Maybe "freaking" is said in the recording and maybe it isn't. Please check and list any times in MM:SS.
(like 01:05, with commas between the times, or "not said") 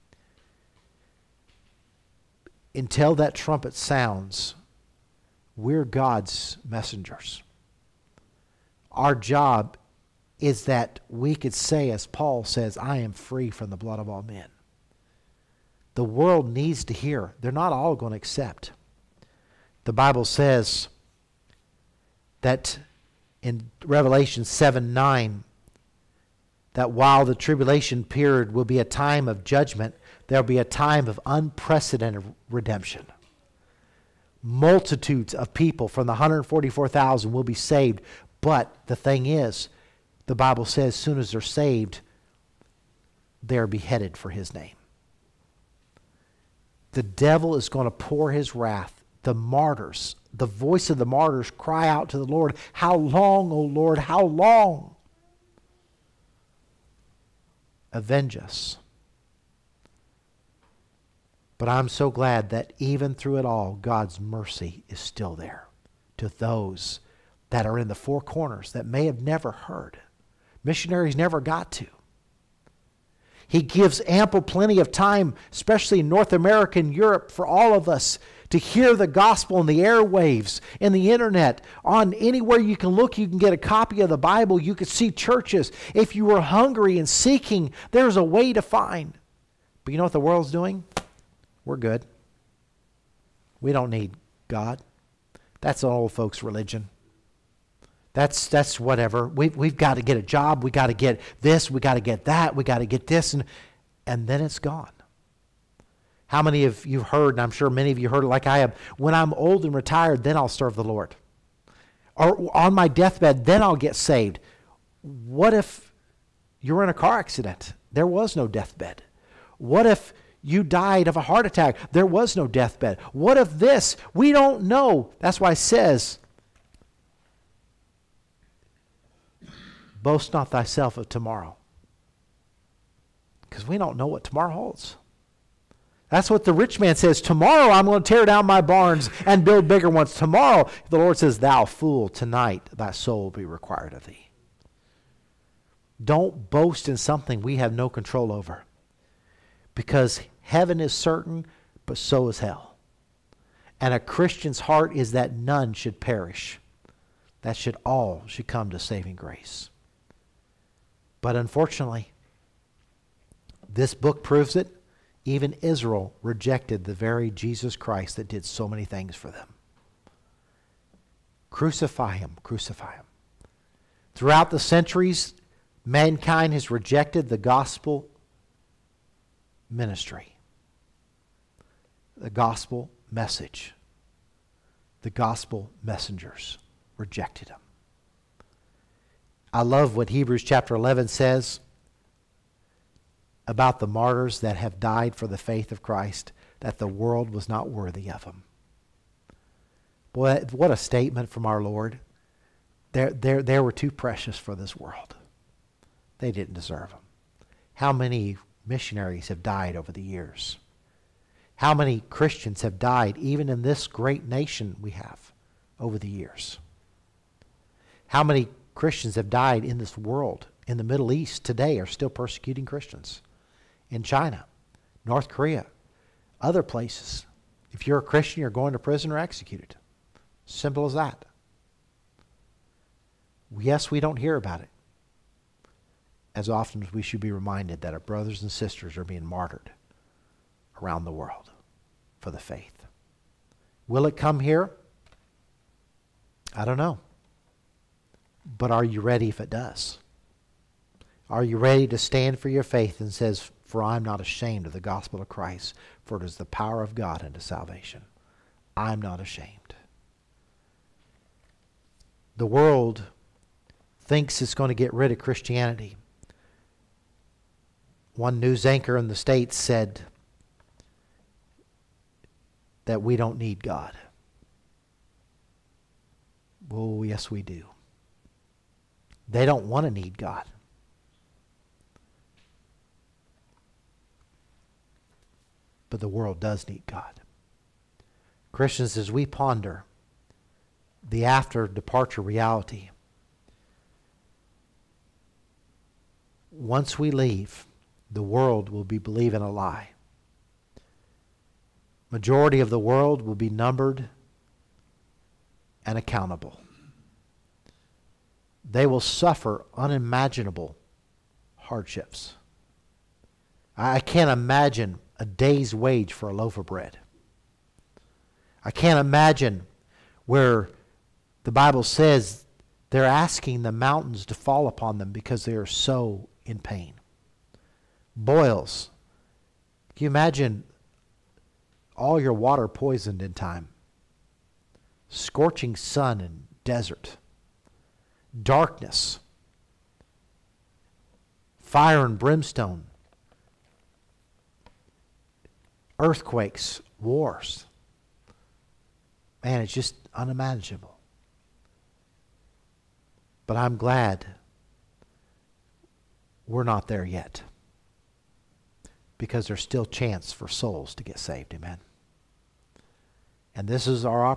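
not said.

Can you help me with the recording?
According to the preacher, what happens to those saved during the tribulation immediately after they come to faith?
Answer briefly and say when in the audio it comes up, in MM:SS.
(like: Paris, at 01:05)
They're beheaded, at 00:43.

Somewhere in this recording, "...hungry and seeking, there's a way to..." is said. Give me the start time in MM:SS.
01:26.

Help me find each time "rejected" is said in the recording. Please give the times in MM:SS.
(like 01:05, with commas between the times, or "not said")
02:46, 02:56, 03:06.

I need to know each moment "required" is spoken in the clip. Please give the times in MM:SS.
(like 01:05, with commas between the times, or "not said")
02:23.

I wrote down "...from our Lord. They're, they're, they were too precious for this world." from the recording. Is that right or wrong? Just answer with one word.
right.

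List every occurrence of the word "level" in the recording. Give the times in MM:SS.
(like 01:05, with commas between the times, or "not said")
not said.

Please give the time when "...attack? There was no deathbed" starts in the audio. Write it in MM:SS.
02:01.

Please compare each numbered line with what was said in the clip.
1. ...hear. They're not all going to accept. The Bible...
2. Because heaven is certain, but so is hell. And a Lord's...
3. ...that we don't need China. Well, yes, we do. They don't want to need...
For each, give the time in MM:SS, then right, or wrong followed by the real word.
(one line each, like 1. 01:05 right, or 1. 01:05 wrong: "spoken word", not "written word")
1. 00:16 right
2. 02:29 wrong: "Christian", not "Lord"
3. 04:32 wrong: "God", not "China".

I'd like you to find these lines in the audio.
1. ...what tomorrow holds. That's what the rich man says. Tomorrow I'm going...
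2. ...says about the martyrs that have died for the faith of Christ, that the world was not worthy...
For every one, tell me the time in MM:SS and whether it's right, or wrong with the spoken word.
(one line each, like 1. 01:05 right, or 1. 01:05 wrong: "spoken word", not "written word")
1. 02:14 right
2. 03:11 right.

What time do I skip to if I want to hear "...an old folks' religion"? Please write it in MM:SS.
01:35.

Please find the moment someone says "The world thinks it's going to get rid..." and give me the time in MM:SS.
04:22.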